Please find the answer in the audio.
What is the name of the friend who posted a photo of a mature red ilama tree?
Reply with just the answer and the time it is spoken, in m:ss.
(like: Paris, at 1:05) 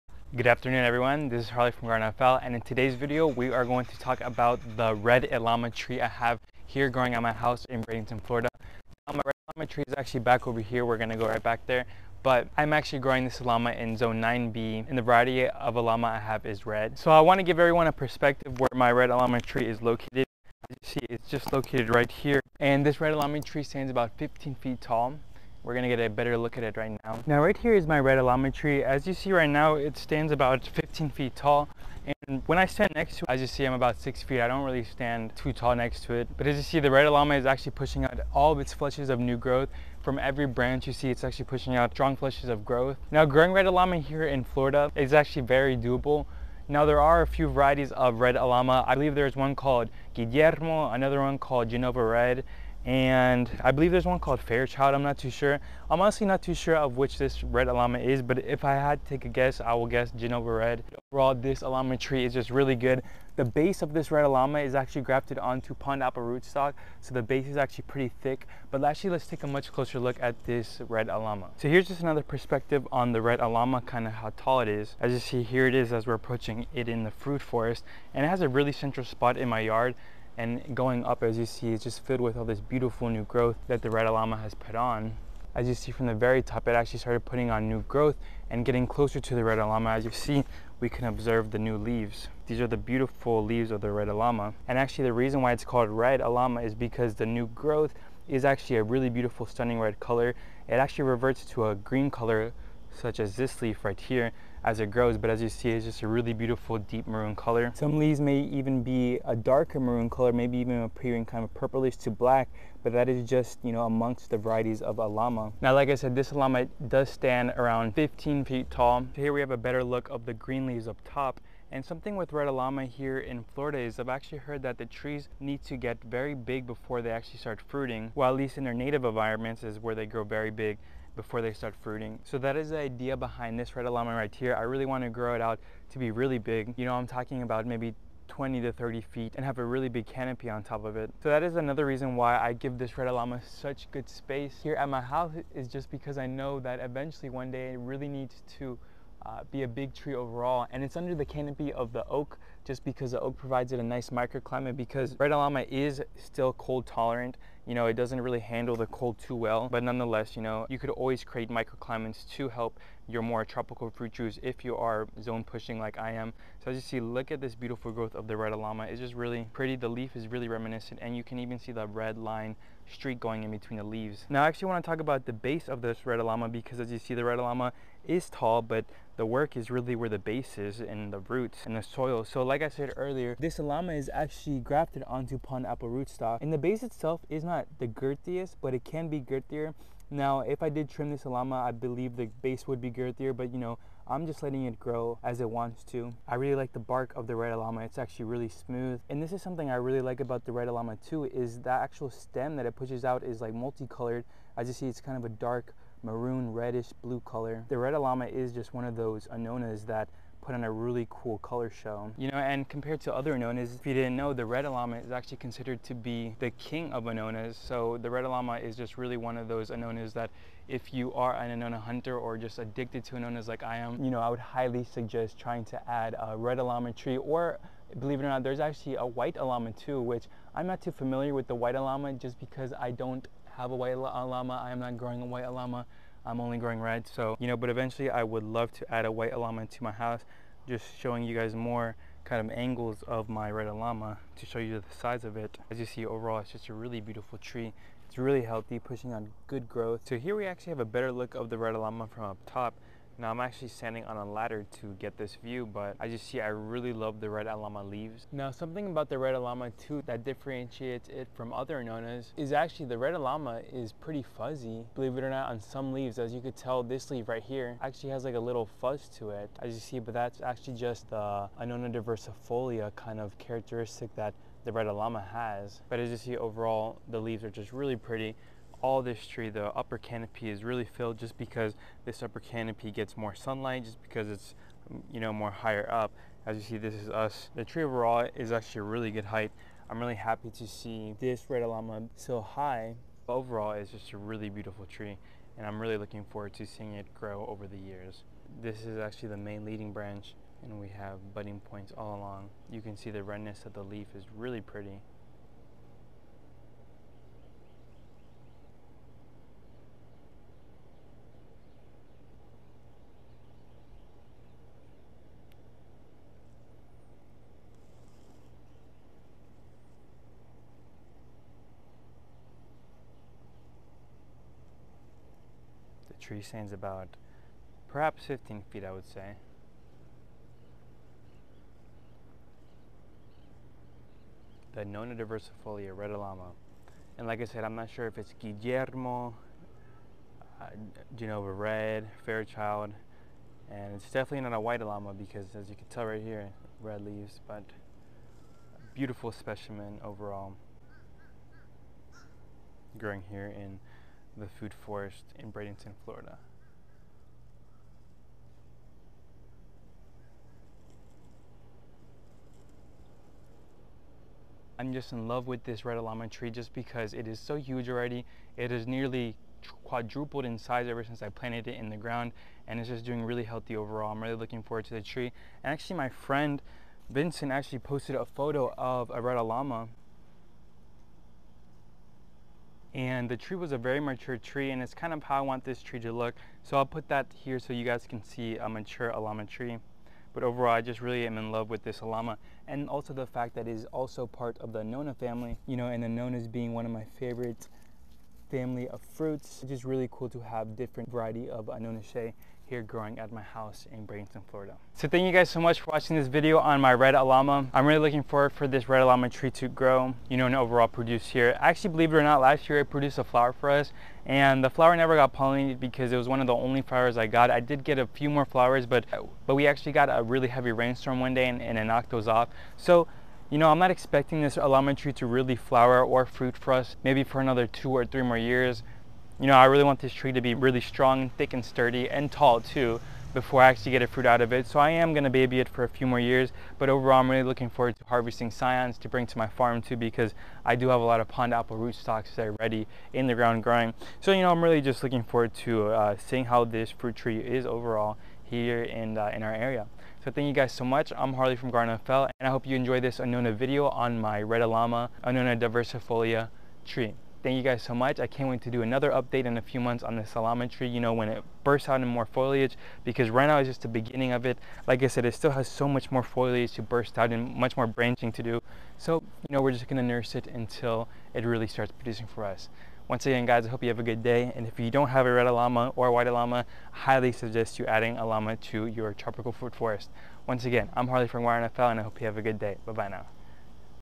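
Vincent, at 6:17.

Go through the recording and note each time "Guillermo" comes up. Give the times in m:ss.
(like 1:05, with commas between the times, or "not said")
0:50, 5:38.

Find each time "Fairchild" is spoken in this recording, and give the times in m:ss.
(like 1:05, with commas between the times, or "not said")
0:54, 5:42.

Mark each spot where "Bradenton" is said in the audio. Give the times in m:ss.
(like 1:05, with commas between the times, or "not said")
0:07, 5:55, 6:44.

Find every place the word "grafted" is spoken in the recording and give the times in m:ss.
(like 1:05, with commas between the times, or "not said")
1:05, 3:04.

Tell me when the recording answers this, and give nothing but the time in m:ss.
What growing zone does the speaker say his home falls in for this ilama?
0:13.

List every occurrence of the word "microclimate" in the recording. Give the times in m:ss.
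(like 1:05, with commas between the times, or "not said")
2:34, 2:41.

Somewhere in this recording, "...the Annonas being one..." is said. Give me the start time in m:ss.
6:36.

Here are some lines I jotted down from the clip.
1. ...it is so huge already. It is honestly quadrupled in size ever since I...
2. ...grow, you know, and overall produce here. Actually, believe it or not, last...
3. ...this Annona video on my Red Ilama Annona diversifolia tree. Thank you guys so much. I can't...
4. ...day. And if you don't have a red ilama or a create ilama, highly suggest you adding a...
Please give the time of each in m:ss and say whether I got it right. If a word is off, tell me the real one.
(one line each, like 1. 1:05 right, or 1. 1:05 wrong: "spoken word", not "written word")
1. 6:07 wrong: "nearly", not "honestly"
2. 6:49 right
3. 7:32 right
4. 7:54 wrong: "white", not "create".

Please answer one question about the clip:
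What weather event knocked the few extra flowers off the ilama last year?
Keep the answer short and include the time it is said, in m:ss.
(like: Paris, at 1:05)
Heavy rainstorm, at 7:00.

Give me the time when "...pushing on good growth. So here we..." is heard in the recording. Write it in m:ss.
4:08.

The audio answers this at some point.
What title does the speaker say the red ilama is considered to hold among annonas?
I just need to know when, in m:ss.
3:36.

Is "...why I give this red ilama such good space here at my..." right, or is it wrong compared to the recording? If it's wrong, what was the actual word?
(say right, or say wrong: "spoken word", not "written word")
right.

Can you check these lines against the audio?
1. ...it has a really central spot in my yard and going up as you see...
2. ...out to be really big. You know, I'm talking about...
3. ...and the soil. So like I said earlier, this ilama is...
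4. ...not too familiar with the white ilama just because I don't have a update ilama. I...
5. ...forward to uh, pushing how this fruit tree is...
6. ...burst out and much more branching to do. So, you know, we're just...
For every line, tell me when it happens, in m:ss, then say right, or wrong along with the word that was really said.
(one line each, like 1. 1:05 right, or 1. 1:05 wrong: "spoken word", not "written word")
1. 1:18 right
2. 2:15 right
3. 3:01 right
4. 3:50 wrong: "white", not "update"
5. 7:25 wrong: "seeing", not "pushing"
6. 7:46 right.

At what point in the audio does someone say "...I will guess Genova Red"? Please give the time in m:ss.
0:59.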